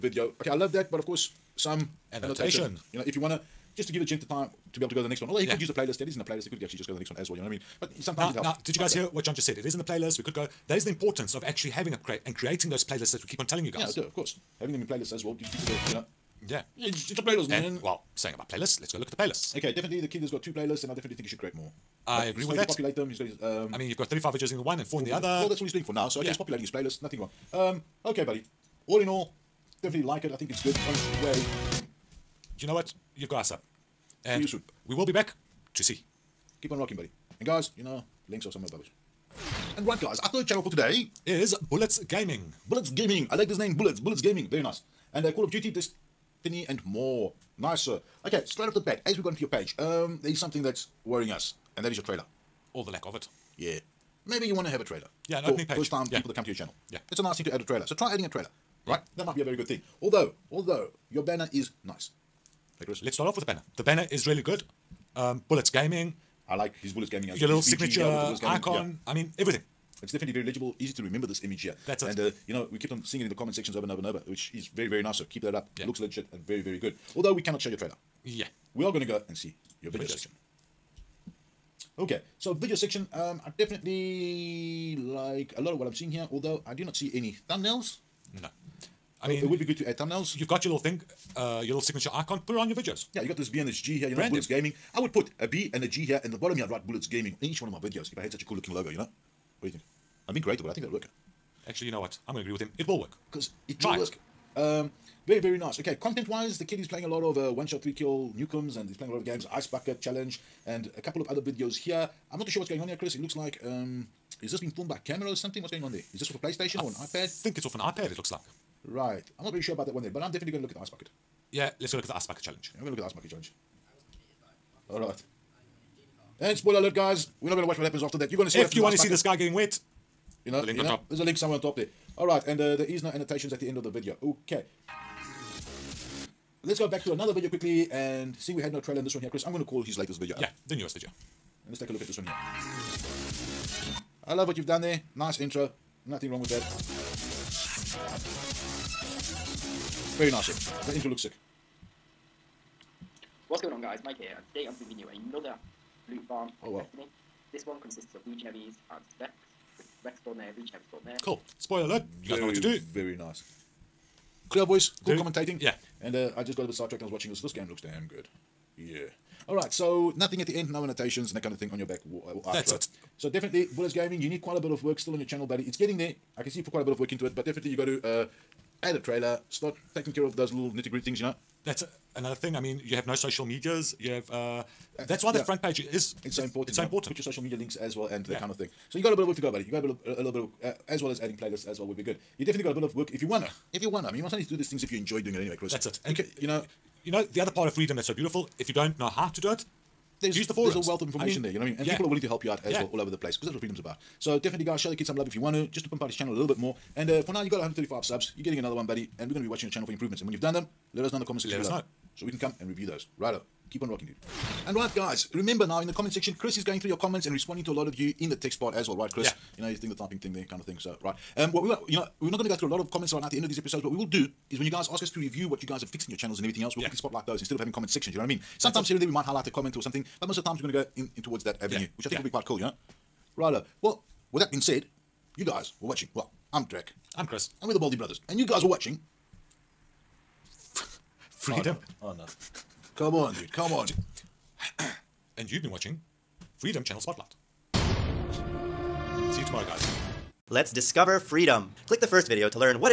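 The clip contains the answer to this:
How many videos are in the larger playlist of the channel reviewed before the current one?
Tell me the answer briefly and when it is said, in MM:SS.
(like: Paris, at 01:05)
35, at 00:24.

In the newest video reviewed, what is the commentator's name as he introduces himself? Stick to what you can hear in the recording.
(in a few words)
Mike.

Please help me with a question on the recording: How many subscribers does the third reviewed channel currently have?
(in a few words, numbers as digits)
135.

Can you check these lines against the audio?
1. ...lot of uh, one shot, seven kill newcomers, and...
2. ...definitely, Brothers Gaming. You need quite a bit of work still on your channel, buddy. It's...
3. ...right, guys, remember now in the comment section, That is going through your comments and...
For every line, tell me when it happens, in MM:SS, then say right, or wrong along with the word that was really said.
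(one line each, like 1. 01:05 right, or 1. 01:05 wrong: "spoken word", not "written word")
1. 01:47 wrong: "three", not "seven"
2. 02:53 wrong: "Bullets", not "Brothers"
3. 03:34 wrong: "Chris", not "That".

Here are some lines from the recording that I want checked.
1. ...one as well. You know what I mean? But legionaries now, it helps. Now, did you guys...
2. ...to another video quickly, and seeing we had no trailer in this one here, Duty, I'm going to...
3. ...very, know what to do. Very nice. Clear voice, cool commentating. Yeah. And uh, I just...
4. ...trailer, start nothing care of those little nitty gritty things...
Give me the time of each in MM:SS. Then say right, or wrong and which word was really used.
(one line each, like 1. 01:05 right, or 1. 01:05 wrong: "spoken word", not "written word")
1. 00:07 wrong: "sometimes", not "legionaries"
2. 02:17 wrong: "Chris", not "Duty"
3. 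02:42 right
4. 02:58 wrong: "taking", not "nothing".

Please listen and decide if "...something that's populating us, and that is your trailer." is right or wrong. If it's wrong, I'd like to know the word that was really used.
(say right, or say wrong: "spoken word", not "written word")
wrong: "worrying", not "populating".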